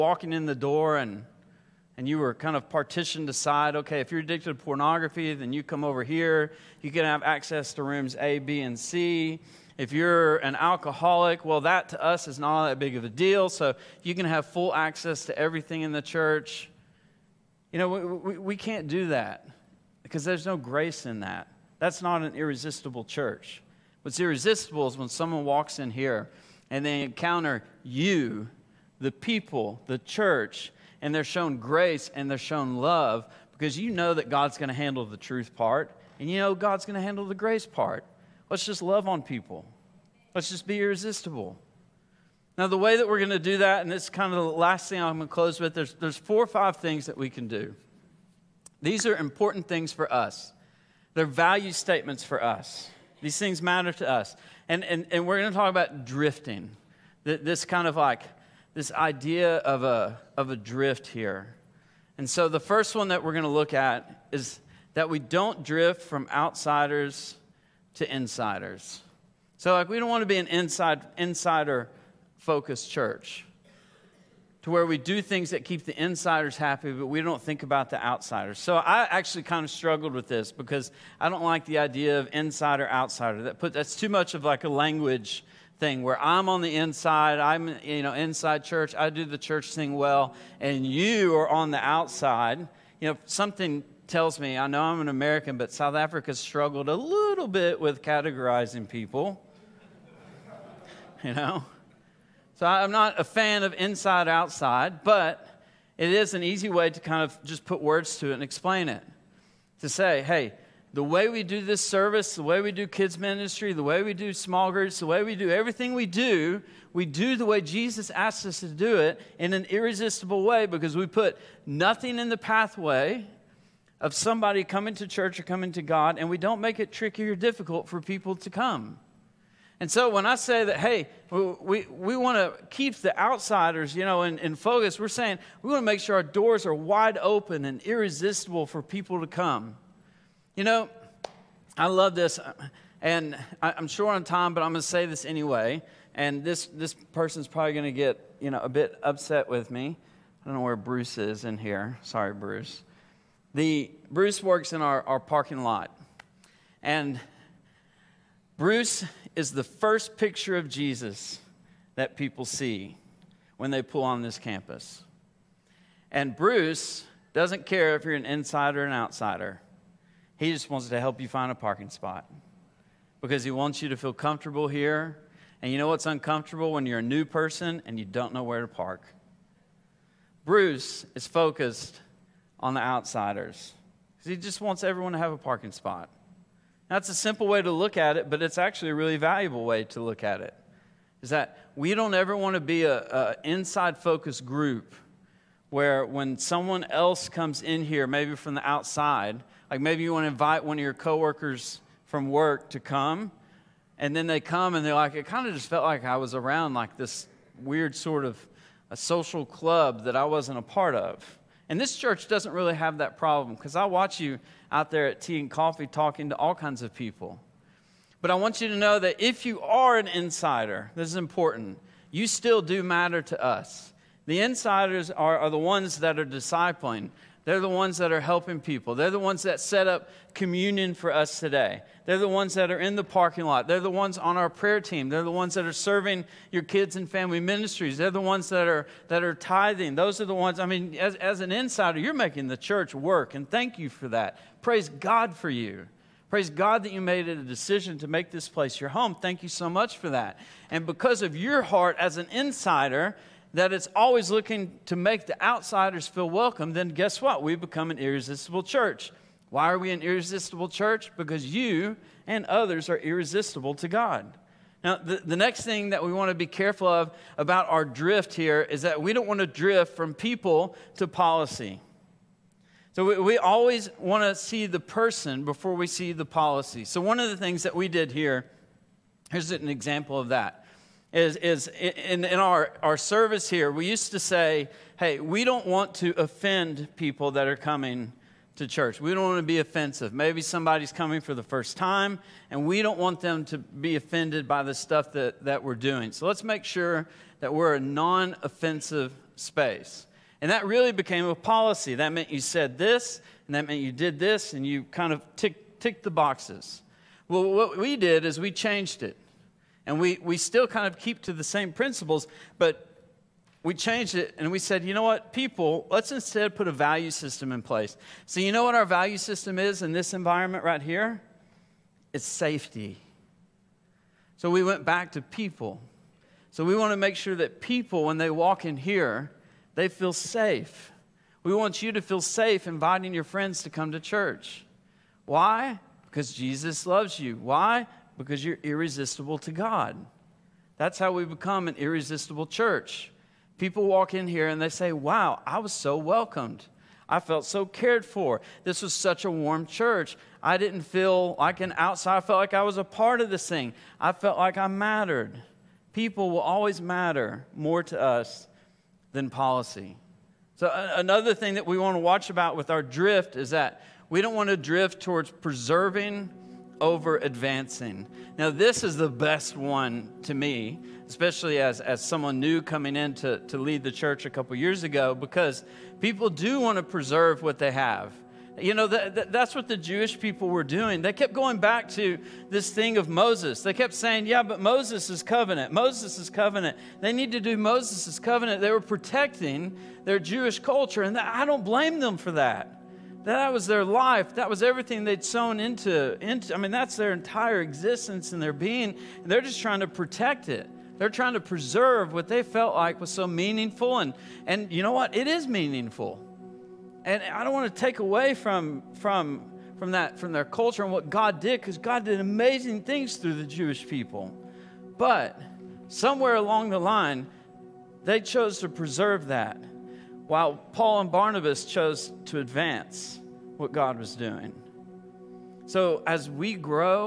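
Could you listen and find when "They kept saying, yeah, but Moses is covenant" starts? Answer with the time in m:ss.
6:23.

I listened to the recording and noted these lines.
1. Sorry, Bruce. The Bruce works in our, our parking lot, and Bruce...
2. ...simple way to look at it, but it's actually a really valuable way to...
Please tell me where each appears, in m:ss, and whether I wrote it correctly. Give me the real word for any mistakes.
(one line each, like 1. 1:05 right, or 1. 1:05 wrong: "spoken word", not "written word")
1. 2:32 right
2. 3:07 right.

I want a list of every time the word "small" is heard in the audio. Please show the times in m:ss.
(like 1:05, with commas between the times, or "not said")
1:54.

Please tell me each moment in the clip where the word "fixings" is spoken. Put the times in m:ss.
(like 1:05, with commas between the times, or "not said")
not said.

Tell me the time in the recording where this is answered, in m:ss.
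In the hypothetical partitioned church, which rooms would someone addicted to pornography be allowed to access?
0:07.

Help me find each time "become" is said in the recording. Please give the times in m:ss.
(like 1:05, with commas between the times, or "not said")
4:17, 5:41.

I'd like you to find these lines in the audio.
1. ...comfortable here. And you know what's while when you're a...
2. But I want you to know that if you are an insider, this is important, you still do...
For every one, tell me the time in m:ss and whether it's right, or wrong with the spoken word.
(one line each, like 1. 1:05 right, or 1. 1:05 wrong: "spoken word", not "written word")
1. 2:54 wrong: "uncomfortable", not "while"
2. 3:38 right.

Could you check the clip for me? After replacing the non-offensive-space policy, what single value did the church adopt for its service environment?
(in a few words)
safety.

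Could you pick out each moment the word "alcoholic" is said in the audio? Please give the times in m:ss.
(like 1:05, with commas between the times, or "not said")
0:10.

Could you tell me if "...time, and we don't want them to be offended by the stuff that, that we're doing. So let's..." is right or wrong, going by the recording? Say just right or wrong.
right.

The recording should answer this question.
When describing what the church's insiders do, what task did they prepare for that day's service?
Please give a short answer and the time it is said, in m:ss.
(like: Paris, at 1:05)
communion, at 3:50.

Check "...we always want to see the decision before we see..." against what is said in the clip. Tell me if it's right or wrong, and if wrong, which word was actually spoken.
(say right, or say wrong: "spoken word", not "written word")
wrong: "person", not "decision".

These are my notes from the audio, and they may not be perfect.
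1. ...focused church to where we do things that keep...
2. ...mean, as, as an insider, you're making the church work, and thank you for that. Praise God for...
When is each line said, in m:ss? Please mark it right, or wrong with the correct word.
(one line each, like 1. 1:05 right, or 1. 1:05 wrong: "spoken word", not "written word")
1. 1:12 right
2. 4:00 right.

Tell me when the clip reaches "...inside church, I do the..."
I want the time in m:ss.
1:28.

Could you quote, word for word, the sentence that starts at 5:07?
Well, what we did is we changed it.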